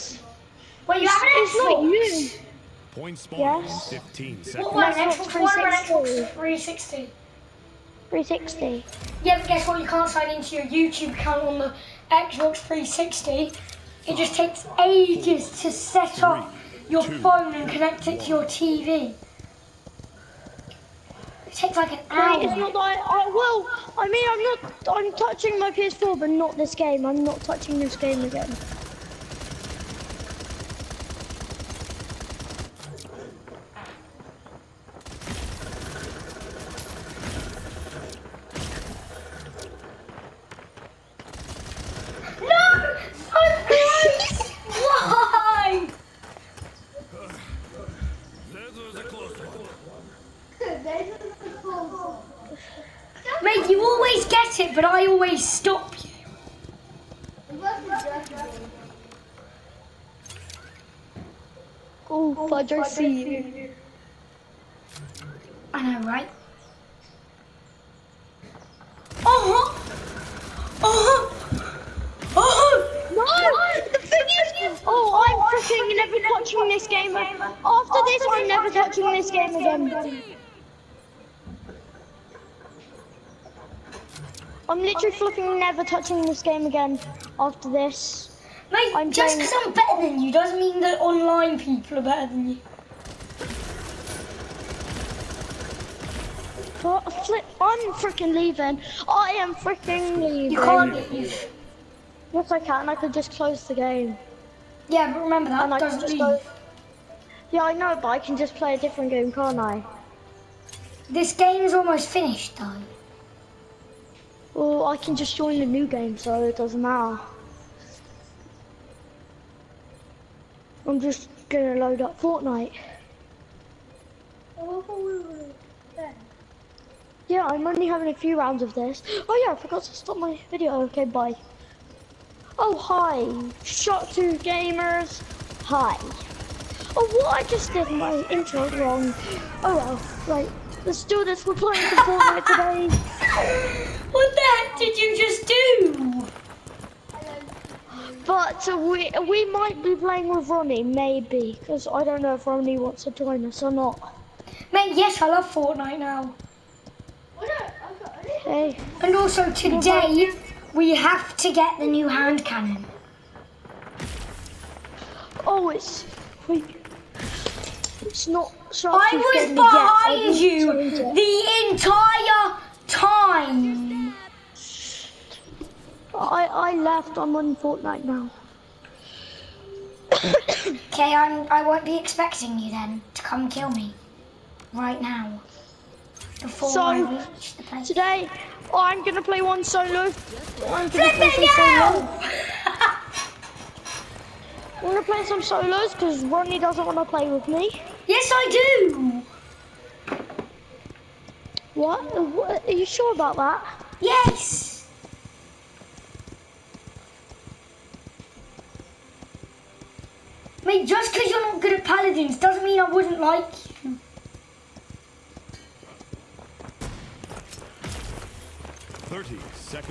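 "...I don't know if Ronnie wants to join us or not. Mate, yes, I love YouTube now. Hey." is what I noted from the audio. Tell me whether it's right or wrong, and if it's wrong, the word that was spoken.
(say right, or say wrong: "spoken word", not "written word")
wrong: "Fortnite", not "YouTube".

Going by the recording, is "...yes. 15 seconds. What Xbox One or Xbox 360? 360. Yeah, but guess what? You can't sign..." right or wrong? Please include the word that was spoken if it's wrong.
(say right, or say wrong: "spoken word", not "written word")
right.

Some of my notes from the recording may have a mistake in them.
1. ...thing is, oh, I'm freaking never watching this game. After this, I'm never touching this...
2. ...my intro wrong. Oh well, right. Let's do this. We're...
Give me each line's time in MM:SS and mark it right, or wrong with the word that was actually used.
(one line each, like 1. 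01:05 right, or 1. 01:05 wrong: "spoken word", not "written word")
1. 01:14 right
2. 02:17 right.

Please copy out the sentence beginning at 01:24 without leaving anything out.
I'm literally flipping never touching this game again after this.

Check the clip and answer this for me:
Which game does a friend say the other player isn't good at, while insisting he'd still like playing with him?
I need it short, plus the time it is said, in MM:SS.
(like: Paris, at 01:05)
Paladins, at 03:31.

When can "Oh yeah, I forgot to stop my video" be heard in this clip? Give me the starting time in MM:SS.
02:09.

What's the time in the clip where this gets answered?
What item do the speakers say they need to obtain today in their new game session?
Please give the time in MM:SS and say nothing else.
02:41.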